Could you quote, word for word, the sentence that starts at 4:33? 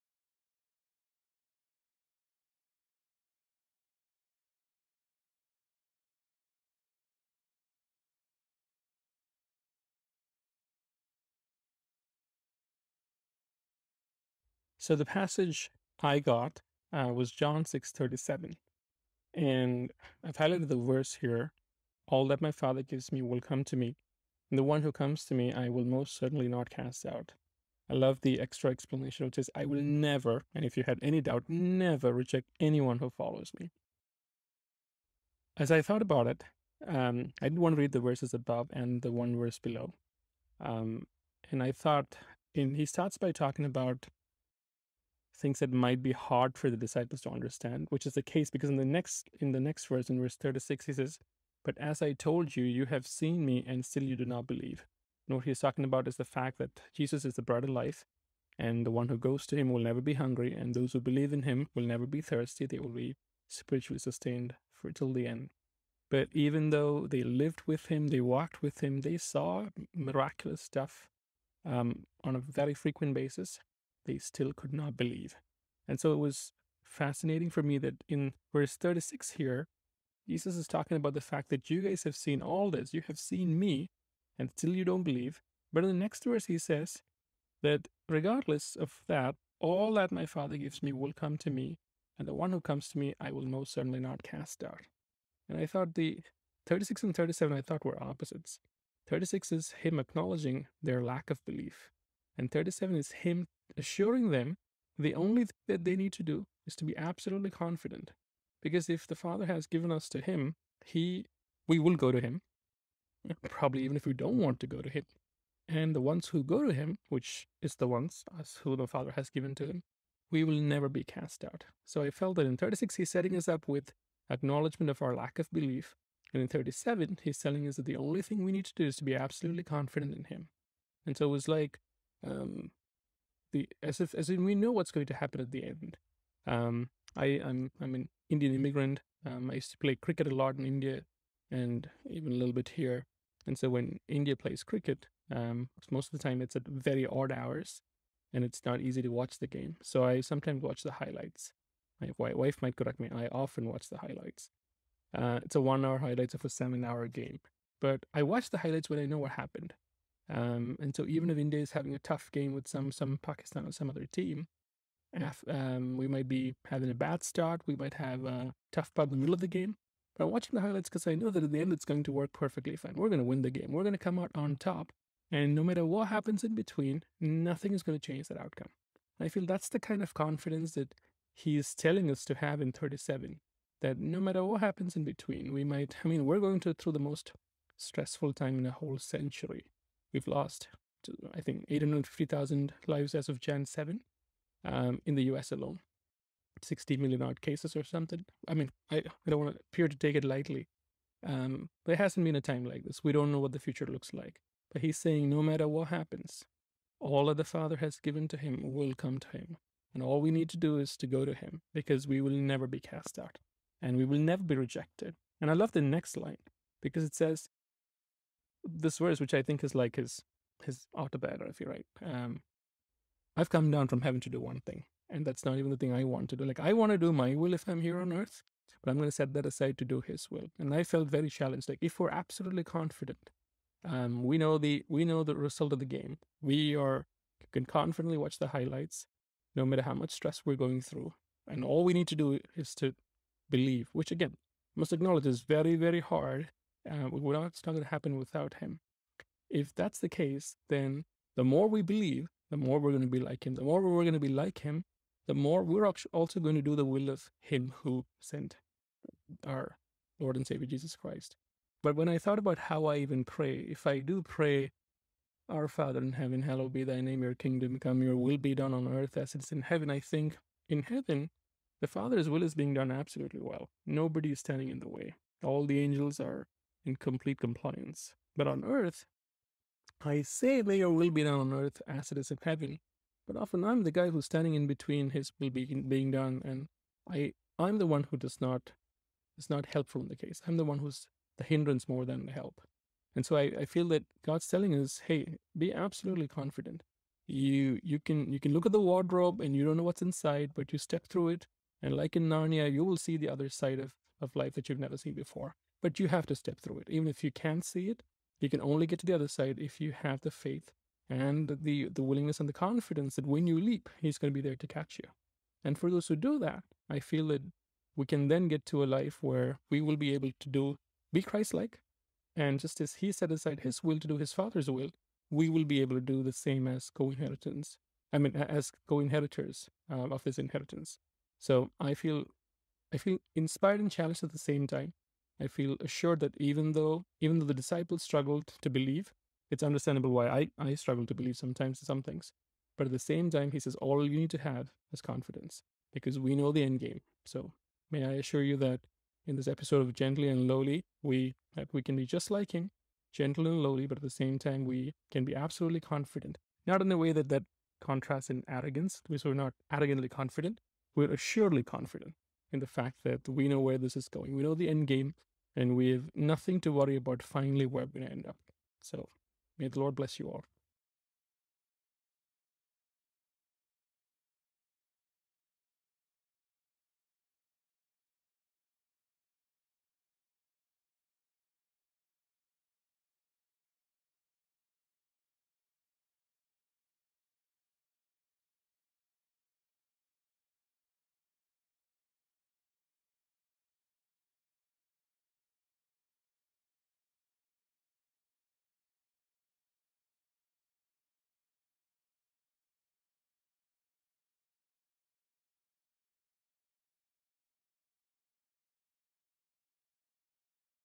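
Nobody is standing in the way.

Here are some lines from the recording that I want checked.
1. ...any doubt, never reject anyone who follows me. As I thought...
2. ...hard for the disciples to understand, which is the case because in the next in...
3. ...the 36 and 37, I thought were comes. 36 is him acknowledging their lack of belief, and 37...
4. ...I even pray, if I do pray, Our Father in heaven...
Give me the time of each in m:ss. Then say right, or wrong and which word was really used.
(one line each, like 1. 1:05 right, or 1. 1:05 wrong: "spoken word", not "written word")
1. 0:31 right
2. 0:46 right
3. 1:35 wrong: "opposites", not "comes"
4. 4:22 right.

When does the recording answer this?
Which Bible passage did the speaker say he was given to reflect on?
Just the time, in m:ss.
0:17.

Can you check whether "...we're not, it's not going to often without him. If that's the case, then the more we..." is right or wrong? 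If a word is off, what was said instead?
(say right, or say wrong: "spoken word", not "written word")
wrong: "happen", not "often".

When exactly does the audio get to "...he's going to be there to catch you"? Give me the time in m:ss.
5:13.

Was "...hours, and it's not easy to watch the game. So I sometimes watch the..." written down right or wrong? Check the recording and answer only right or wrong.
right.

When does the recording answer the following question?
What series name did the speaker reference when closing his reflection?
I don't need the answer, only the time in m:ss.
5:49.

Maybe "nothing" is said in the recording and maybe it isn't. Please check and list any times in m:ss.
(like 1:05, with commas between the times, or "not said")
2:57, 6:06.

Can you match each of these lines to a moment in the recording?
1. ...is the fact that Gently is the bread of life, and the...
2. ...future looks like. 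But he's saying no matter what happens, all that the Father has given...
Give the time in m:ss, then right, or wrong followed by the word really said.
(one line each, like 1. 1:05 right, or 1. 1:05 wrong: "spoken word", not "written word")
1. 0:56 wrong: "Jesus", not "Gently"
2. 3:23 right.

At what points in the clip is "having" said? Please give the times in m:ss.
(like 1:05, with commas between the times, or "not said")
2:41, 2:46.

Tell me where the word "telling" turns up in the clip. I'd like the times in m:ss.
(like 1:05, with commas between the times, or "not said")
2:07, 3:01, 4:54.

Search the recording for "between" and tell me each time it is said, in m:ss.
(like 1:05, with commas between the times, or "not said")
2:56, 3:05, 4:44.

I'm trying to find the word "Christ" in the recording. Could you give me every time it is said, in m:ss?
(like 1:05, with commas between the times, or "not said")
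4:20, 5:21.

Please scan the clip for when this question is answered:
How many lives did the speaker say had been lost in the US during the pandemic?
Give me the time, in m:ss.
3:11.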